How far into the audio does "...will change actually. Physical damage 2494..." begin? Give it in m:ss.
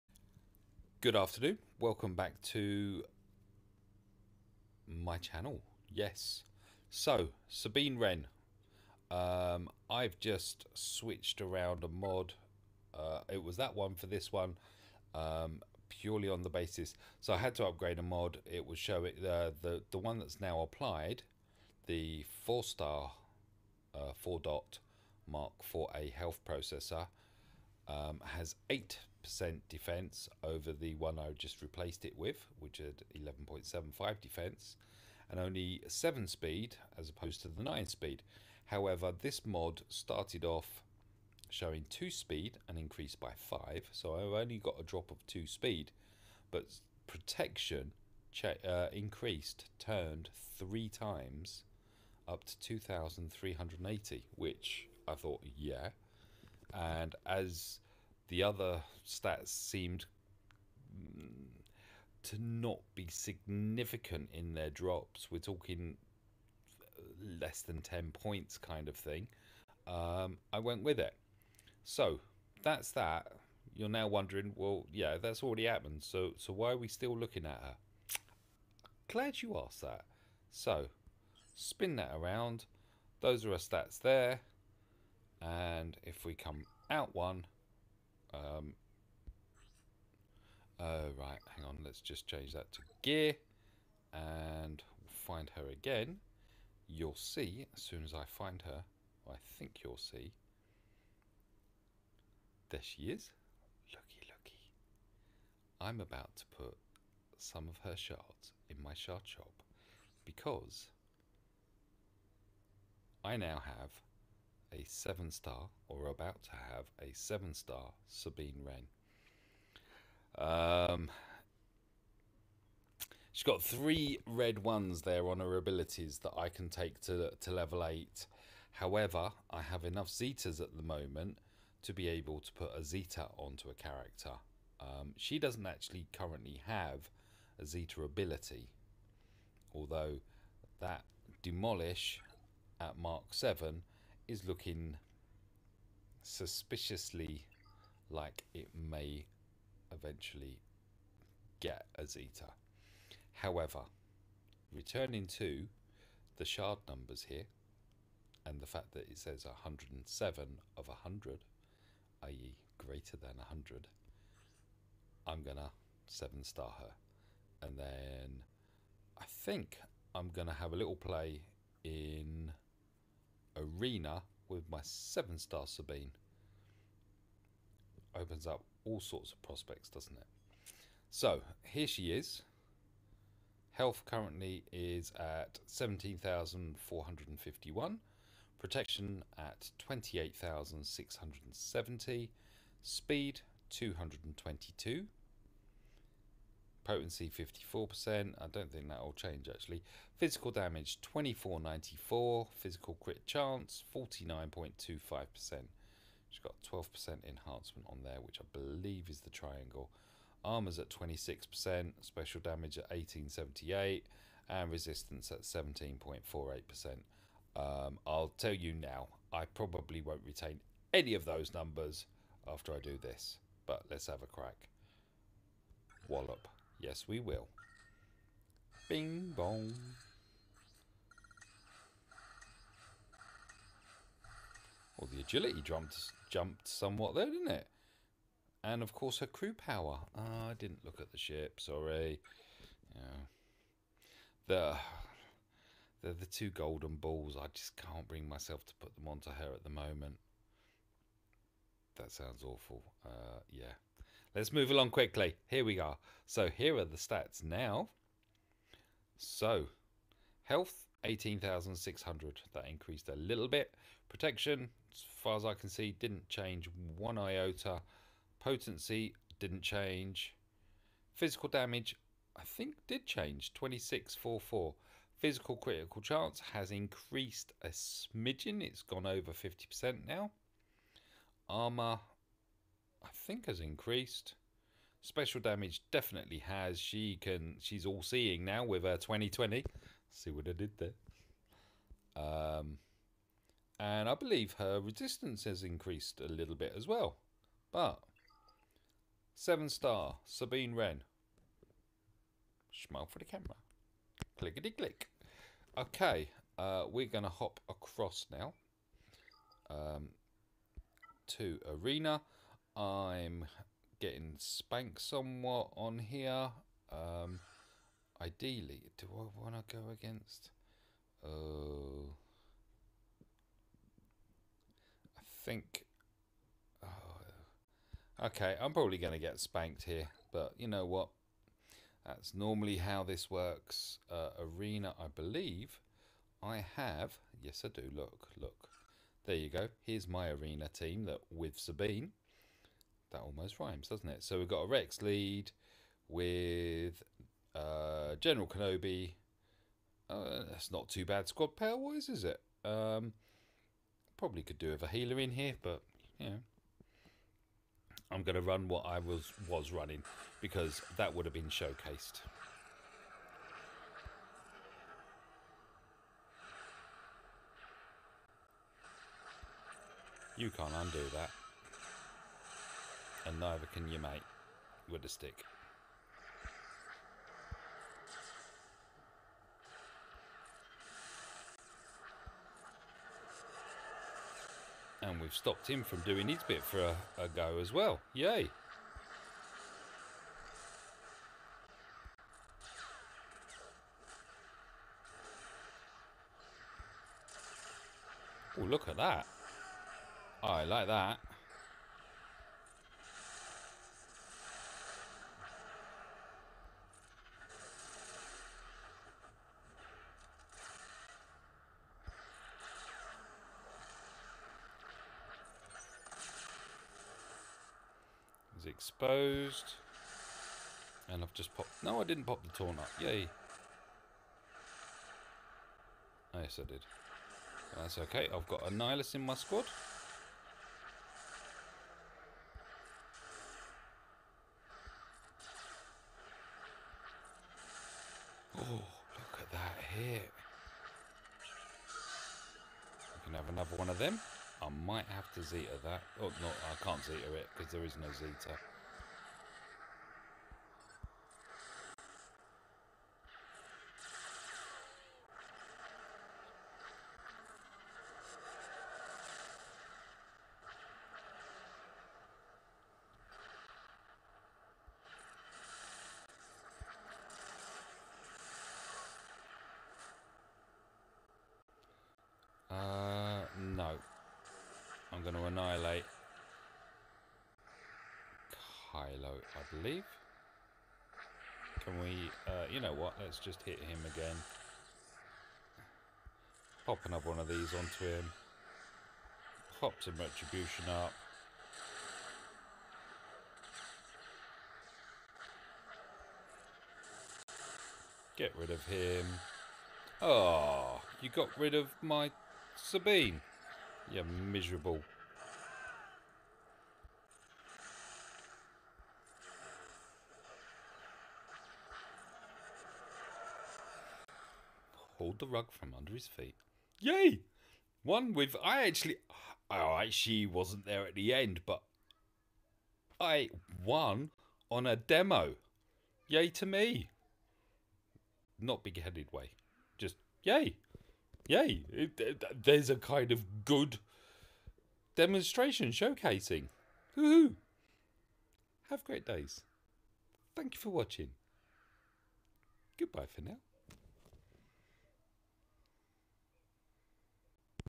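3:18.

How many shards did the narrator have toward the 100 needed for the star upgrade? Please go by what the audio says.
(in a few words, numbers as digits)
107.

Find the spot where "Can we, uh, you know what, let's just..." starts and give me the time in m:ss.
8:01.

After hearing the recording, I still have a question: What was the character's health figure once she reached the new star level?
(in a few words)
18,600.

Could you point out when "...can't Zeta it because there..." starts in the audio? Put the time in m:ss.
7:26.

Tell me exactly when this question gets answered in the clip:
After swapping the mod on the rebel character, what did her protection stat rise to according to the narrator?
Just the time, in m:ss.
0:52.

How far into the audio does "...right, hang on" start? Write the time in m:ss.
1:31.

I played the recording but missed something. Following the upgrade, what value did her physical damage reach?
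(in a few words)
2644.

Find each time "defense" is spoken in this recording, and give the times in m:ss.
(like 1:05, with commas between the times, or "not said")
0:29, 0:34.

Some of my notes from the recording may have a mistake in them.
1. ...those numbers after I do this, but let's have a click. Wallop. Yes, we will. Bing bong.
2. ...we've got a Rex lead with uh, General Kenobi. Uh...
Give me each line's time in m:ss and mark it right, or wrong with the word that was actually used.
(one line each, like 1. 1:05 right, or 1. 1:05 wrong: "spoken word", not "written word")
1. 3:41 wrong: "crack", not "click"
2. 5:44 right.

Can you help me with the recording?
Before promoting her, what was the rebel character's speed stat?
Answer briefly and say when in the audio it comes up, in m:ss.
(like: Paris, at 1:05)
222, at 3:12.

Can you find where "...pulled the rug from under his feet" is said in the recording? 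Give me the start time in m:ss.
8:35.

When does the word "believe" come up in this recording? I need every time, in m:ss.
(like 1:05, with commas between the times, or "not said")
3:28, 4:54, 5:35, 7:59.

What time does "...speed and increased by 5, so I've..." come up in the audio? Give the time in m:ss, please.
0:42.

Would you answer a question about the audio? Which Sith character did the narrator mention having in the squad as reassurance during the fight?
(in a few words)
Nihilus.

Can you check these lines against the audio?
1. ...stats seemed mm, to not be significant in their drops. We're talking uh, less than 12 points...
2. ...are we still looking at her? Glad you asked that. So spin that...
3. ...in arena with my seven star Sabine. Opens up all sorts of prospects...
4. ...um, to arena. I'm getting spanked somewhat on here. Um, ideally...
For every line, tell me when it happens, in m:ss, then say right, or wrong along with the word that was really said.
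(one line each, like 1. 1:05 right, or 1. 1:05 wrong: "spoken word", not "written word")
1. 0:59 wrong: "10", not "12"
2. 1:16 right
3. 2:51 right
4. 5:09 right.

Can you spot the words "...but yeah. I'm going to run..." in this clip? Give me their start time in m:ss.
5:55.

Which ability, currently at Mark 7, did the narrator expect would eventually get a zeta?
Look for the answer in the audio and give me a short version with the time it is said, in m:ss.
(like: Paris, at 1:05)
Demolish, at 2:21.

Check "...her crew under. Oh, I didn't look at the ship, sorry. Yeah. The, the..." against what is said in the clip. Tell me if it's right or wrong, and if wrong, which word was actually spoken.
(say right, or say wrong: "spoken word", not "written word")
wrong: "power", not "under".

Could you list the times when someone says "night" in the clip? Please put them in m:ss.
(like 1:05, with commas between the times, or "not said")
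not said.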